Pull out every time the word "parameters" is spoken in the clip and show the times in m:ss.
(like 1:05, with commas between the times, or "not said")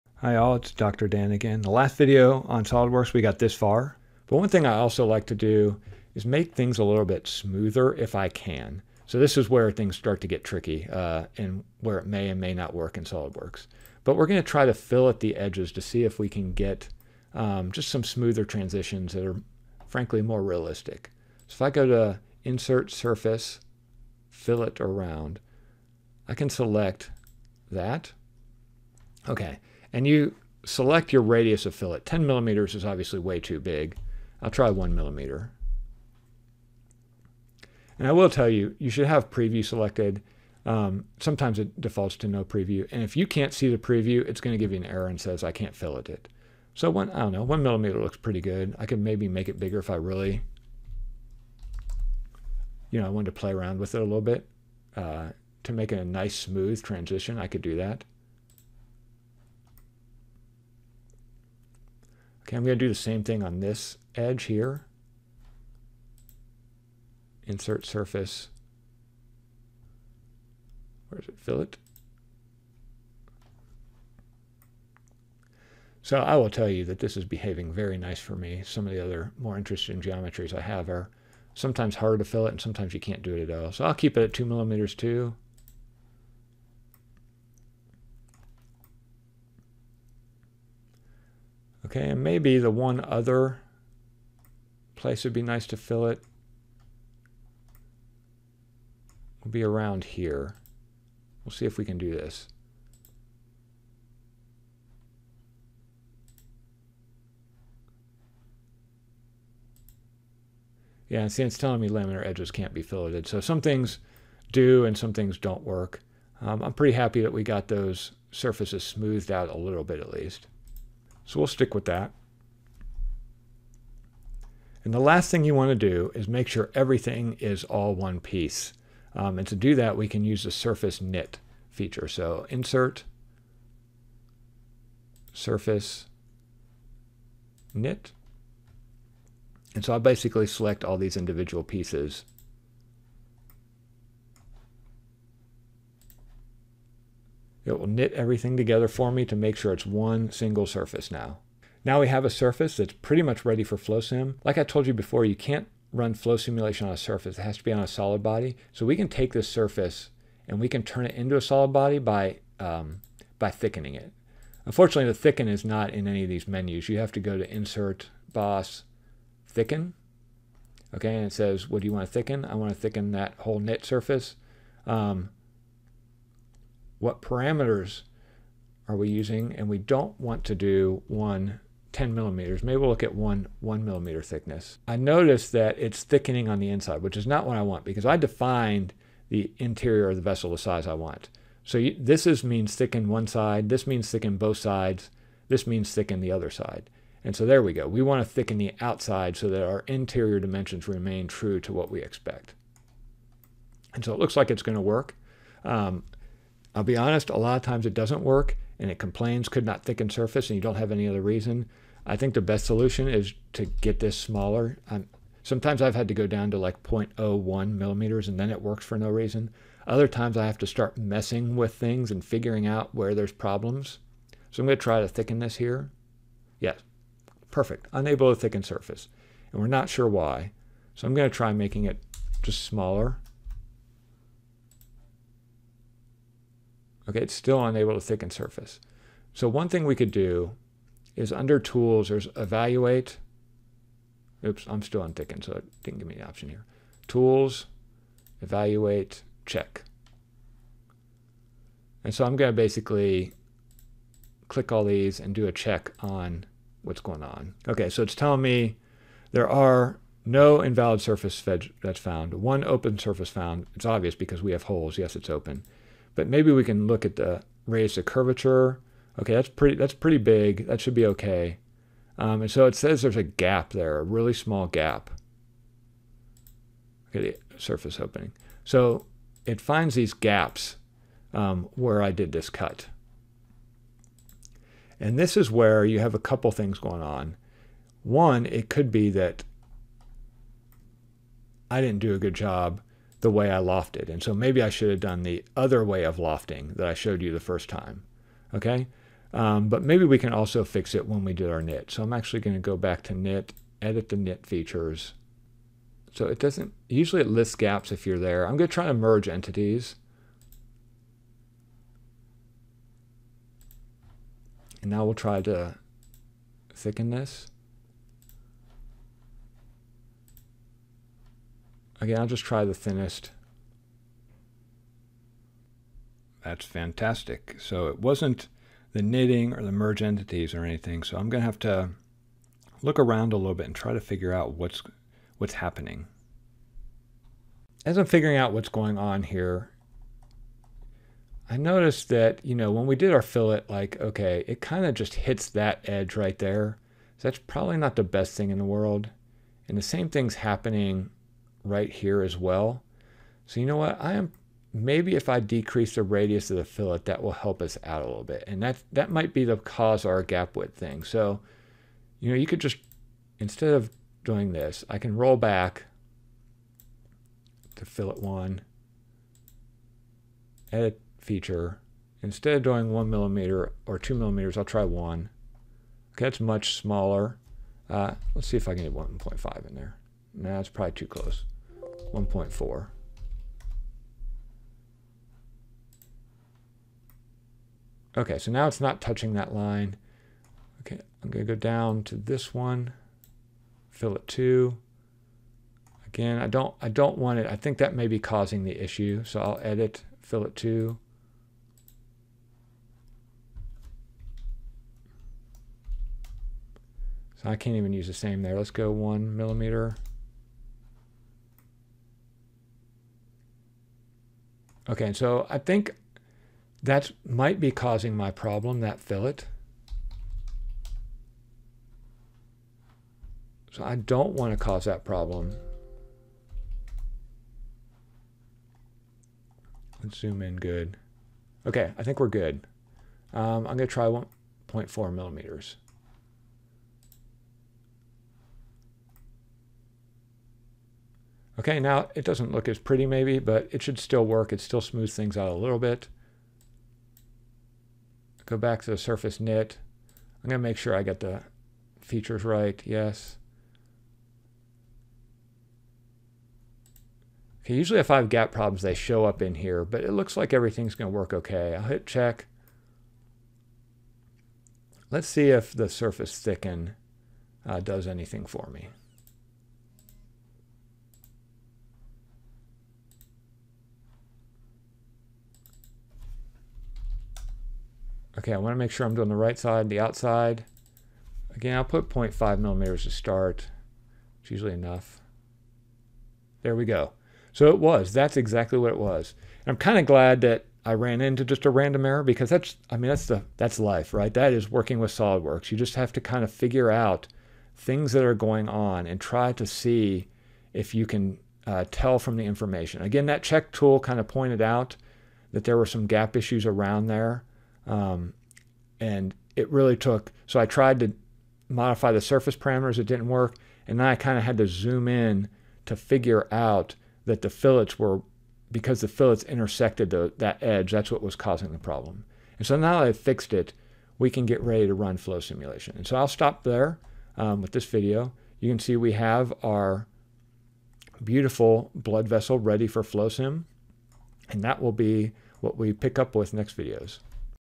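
2:57, 8:32.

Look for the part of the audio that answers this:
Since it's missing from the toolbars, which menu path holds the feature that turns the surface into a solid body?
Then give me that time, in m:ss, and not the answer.
2:47.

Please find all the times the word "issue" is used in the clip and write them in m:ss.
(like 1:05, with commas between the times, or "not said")
6:38, 8:26.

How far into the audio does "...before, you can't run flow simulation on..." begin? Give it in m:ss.
2:34.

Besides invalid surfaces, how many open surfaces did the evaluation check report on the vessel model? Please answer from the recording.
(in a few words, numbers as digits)
1.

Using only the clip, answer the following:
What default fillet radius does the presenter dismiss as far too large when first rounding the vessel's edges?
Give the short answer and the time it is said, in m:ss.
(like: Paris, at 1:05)
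10 millimeters, at 0:31.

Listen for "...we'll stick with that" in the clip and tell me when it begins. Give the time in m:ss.
2:01.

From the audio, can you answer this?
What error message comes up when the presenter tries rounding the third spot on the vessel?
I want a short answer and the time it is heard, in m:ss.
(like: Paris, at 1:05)
laminar edges can't be filleted, at 1:51.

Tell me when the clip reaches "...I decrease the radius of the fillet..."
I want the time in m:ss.
5:55.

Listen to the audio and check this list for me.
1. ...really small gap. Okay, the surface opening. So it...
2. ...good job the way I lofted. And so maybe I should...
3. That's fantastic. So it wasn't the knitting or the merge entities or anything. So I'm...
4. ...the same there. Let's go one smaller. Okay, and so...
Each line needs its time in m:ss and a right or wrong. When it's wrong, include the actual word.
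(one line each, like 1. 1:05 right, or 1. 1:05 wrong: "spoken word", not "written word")
1. 4:34 right
2. 4:52 right
3. 5:26 right
4. 6:48 wrong: "millimeter", not "smaller".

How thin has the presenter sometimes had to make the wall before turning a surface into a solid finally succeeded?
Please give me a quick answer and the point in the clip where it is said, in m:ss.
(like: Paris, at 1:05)
0.01 millimeters, at 3:36.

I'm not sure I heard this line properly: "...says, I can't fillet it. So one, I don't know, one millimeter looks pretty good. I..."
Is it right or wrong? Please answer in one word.
right.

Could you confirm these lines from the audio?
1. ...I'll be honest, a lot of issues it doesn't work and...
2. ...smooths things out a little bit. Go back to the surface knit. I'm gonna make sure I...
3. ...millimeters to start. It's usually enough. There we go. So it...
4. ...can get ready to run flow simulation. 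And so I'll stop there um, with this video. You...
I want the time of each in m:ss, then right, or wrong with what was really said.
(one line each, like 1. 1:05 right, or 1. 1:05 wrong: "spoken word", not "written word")
1. 3:26 wrong: "times", not "issues"
2. 7:24 right
3. 8:02 right
4. 8:44 right.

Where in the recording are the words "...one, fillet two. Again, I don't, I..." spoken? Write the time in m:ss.
6:32.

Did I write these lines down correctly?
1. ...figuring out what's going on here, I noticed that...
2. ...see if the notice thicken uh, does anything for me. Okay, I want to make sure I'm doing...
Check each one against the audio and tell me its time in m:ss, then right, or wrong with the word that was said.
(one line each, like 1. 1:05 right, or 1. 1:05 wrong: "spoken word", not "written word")
1. 5:38 right
2. 7:45 wrong: "surface", not "notice".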